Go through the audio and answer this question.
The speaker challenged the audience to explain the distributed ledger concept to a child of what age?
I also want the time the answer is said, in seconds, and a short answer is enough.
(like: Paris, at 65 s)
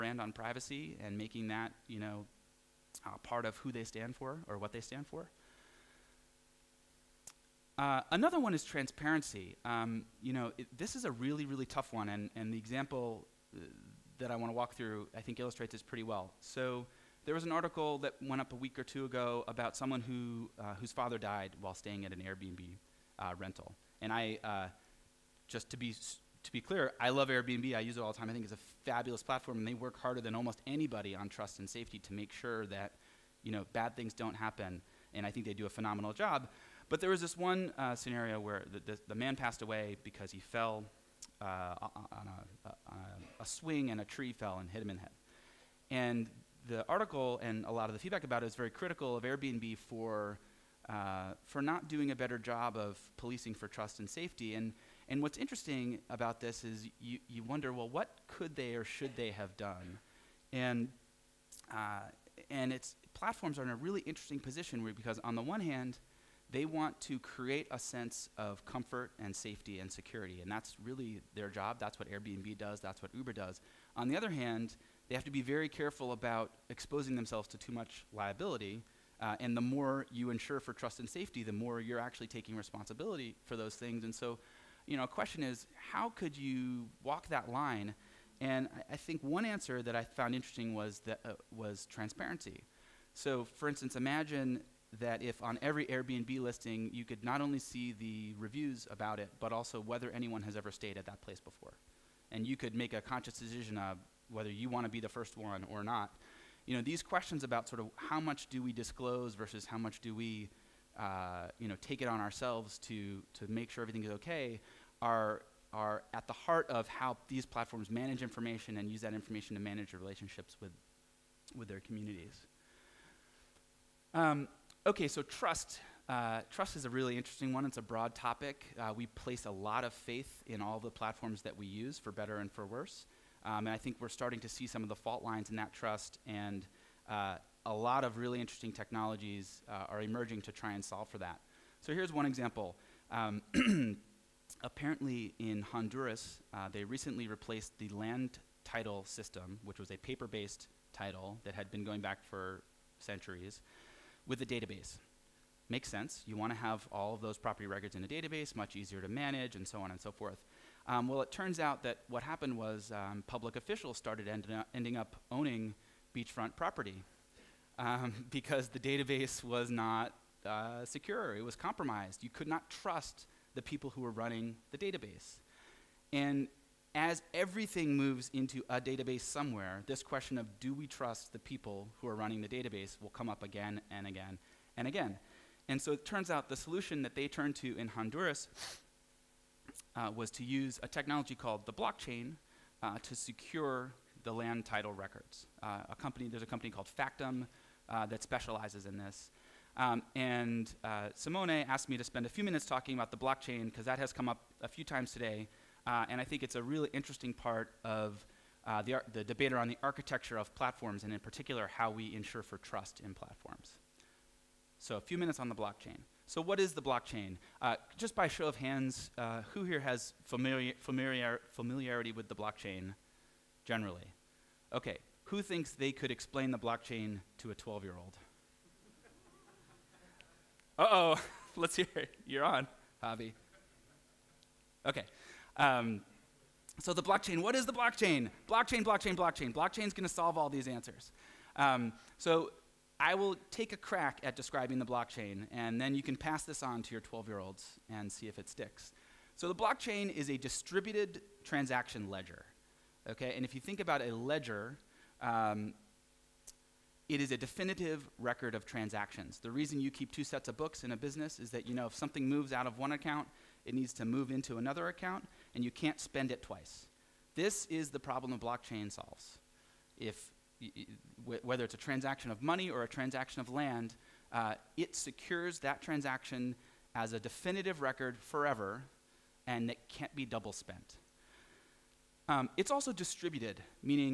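12, at 227 s.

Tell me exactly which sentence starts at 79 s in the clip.
Uh, and the more you insure for trust and safety, the more you're actually taking responsibility for those things.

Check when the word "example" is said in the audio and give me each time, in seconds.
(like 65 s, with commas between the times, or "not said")
12 s, 142 s.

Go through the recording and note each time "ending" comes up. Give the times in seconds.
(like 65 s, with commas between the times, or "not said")
164 s.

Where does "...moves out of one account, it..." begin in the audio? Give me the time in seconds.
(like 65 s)
262 s.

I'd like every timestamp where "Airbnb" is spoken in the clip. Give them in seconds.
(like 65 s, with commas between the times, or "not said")
22 s, 27 s, 49 s, 72 s, 95 s.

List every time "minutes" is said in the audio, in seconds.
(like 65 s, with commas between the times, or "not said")
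202 s, 215 s.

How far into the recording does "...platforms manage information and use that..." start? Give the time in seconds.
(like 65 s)
117 s.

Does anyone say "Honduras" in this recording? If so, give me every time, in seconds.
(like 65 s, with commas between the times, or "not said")
145 s, 187 s.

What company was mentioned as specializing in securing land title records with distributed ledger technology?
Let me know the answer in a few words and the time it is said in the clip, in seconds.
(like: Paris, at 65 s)
Factom, at 196 s.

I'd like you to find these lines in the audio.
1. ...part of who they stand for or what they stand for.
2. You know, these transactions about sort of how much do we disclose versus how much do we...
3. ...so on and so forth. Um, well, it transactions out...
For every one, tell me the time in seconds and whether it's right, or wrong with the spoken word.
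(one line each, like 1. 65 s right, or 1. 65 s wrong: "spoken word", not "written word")
1. 3 s right
2. 106 s wrong: "questions", not "transactions"
3. 159 s wrong: "turns", not "transactions".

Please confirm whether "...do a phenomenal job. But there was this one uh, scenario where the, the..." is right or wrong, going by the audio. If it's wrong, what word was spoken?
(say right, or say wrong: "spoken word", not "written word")
right.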